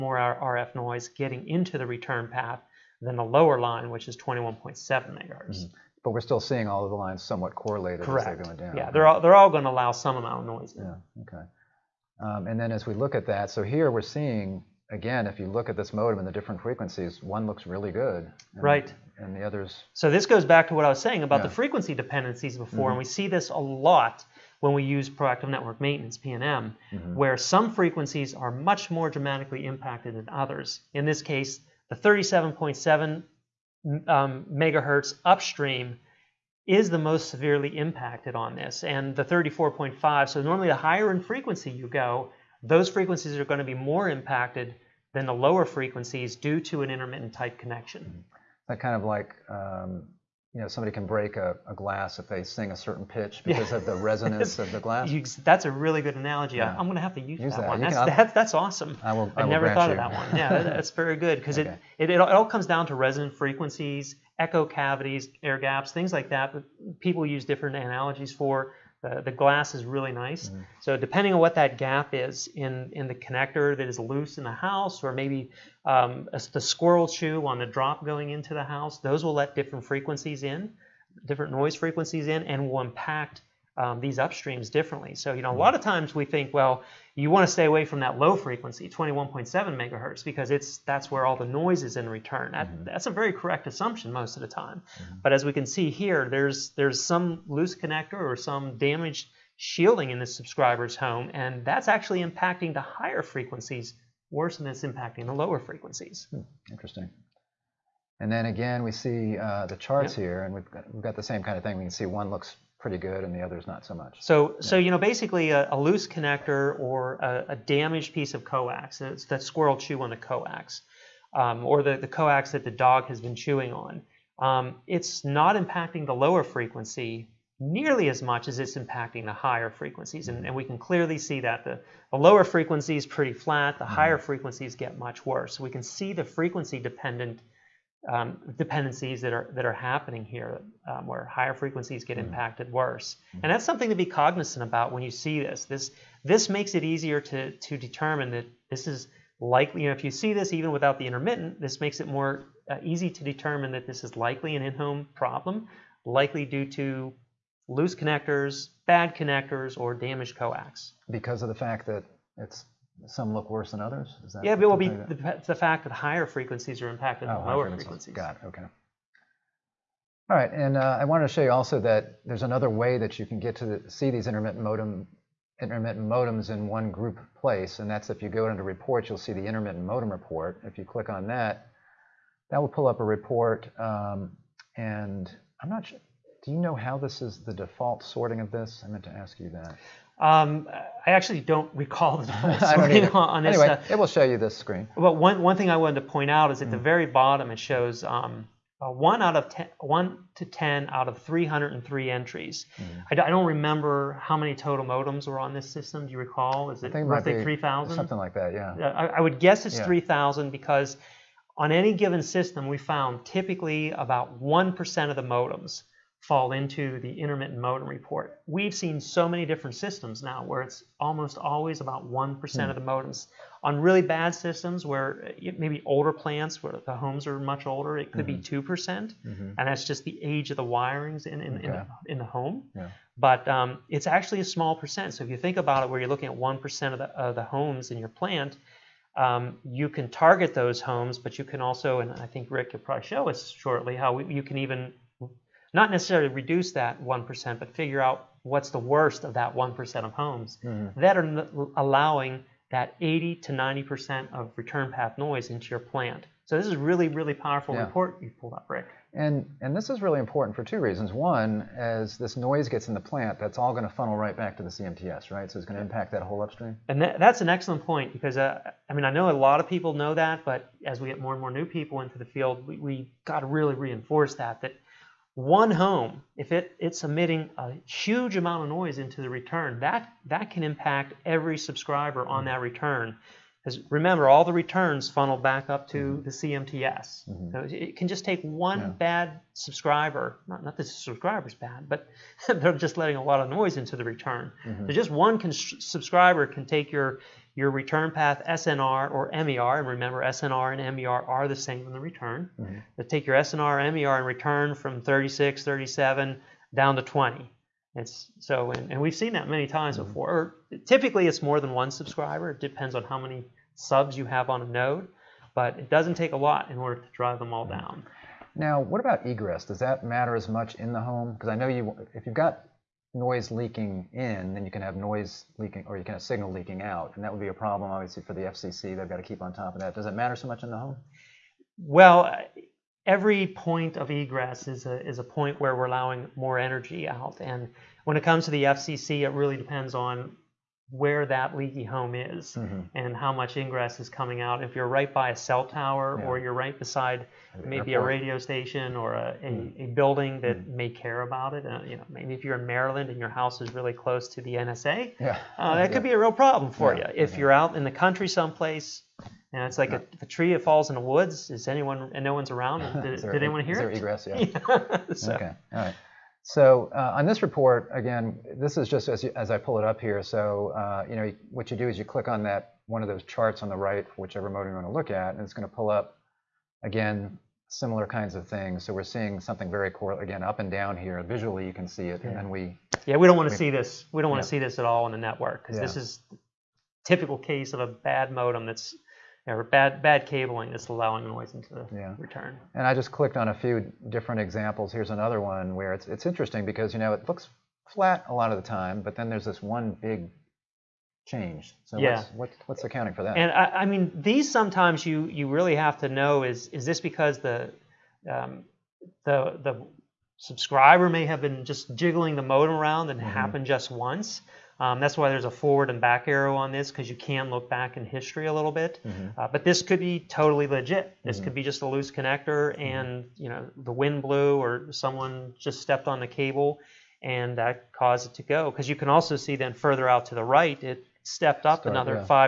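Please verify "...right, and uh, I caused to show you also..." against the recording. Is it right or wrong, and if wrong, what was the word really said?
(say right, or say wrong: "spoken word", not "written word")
wrong: "wanted", not "caused".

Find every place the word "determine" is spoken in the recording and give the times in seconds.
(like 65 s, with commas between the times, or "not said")
147 s, 153 s.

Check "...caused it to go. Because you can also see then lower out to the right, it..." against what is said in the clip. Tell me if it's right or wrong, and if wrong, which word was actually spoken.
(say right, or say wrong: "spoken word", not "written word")
wrong: "further", not "lower".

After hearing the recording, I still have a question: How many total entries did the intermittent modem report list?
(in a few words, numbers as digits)
303.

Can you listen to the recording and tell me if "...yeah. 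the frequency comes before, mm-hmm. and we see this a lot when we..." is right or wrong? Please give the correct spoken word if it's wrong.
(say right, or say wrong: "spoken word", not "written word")
wrong: "dependencies", not "comes".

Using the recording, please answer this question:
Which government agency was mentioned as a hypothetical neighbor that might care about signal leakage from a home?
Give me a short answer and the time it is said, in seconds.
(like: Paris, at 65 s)
NSA, at 354 s.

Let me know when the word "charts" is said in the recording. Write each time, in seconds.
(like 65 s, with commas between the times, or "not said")
109 s, 373 s.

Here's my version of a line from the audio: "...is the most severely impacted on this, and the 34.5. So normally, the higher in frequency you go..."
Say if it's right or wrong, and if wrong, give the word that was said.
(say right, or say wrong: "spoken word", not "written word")
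right.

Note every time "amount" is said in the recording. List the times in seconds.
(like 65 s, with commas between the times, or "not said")
10 s, 278 s.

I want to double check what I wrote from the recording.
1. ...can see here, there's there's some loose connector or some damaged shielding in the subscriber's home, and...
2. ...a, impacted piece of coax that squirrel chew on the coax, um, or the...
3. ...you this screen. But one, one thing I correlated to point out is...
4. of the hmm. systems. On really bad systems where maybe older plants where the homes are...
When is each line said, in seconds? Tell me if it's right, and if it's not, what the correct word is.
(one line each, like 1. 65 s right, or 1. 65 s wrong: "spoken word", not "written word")
1. 95 s right
2. 117 s wrong: "damaged", not "impacted"
3. 194 s wrong: "wanted", not "correlated"
4. 222 s wrong: "modems", not "systems".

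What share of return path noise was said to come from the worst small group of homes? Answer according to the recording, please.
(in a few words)
80 to 90%.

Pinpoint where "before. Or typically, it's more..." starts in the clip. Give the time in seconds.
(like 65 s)
310 s.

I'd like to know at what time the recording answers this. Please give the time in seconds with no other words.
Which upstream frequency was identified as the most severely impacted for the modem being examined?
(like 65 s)
31 s.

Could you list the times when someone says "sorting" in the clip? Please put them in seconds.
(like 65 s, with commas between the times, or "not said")
188 s, 192 s.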